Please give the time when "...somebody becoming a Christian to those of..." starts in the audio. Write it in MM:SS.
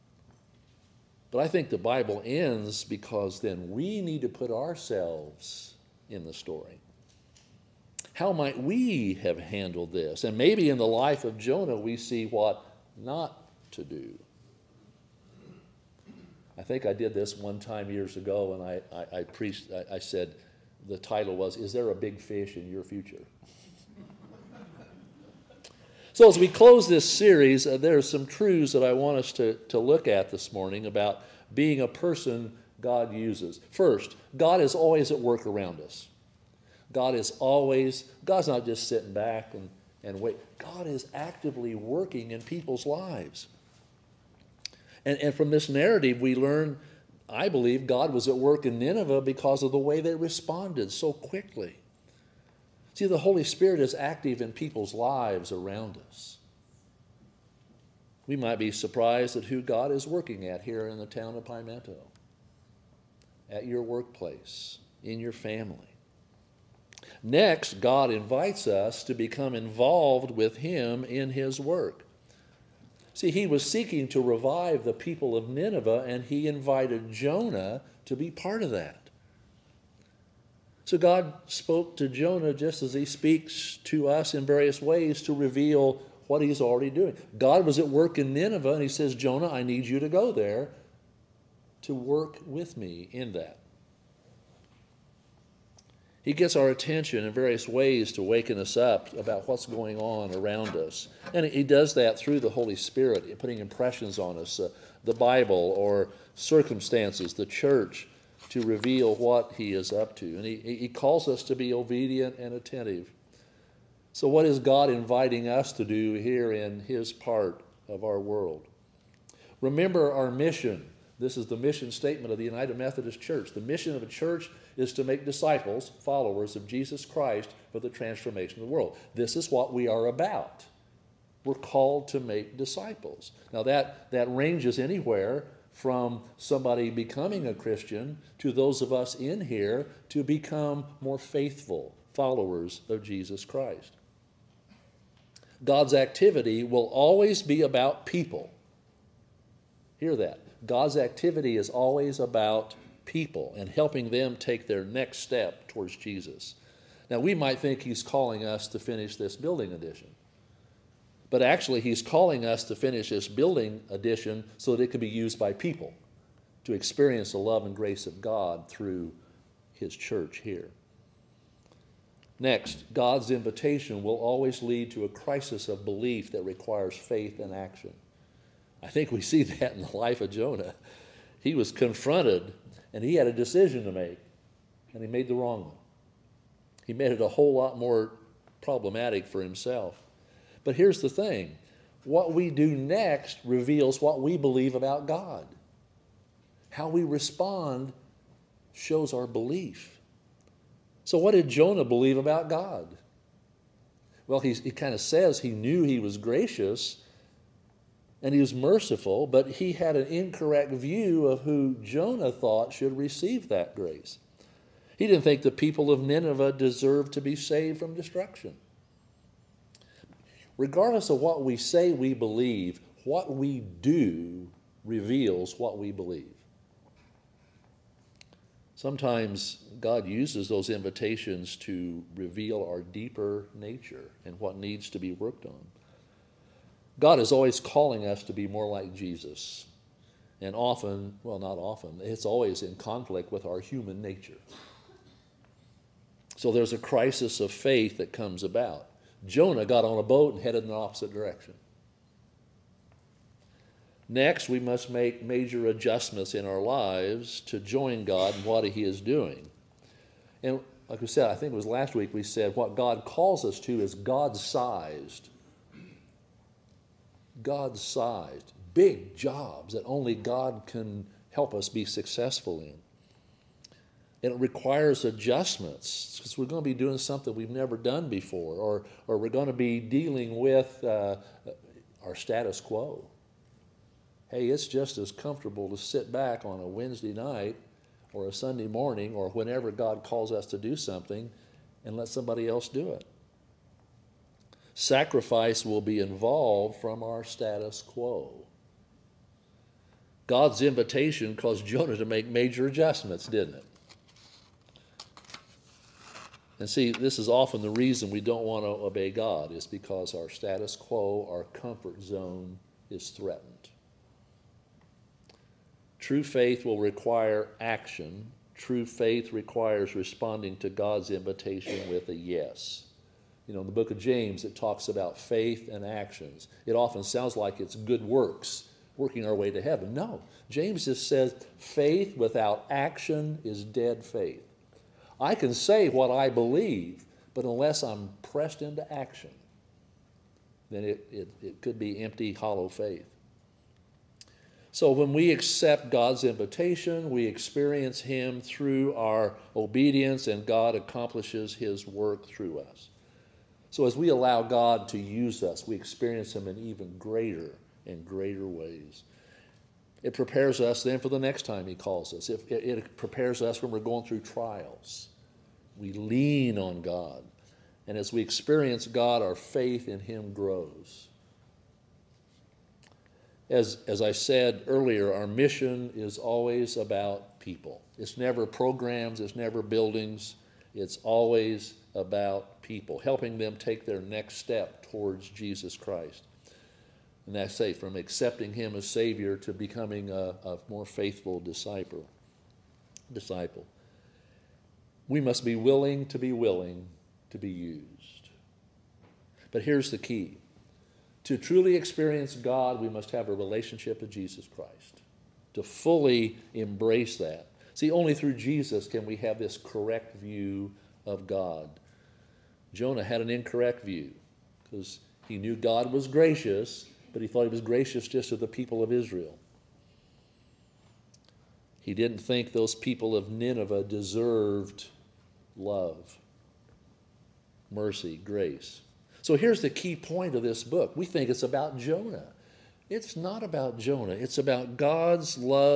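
02:16.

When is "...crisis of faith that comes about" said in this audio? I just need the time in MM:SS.
04:06.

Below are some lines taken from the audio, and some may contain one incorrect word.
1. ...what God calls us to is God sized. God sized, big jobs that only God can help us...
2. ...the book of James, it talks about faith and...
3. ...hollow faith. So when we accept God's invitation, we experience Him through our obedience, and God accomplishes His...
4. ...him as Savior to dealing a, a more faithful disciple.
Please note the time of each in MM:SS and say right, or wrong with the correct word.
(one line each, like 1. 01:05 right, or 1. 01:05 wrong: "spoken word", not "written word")
1. 04:22 right
2. 05:23 right
3. 05:42 right
4. 06:28 wrong: "becoming", not "dealing".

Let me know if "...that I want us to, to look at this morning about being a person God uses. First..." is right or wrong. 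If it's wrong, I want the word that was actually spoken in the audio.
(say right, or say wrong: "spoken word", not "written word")
right.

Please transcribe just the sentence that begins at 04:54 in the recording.
Sacrifice will be involved from our status quo.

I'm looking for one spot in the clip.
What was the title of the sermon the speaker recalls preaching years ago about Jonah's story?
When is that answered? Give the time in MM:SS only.
00:21.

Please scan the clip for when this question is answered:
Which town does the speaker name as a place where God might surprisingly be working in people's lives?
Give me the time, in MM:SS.
01:01.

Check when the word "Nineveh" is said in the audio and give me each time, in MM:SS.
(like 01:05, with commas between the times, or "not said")
00:48, 01:15, 01:28, 03:36, 07:03.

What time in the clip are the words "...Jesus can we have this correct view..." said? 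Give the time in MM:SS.
06:48.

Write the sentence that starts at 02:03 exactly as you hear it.
The mission of a church is to make disciples, followers of Jesus Christ for the transformation of the world.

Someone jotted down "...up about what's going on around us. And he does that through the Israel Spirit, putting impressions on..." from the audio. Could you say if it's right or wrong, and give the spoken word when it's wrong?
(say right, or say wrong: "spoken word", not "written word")
wrong: "Holy", not "Israel".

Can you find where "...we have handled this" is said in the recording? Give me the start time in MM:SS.
00:08.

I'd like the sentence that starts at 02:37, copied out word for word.
Now, we might think he's calling us to finish this building addition.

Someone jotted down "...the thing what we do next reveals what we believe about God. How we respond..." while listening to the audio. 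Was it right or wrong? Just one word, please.
right.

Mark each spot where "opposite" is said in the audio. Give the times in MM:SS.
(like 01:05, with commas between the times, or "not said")
04:10.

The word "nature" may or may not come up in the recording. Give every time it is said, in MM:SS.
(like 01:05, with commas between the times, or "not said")
03:53, 04:04.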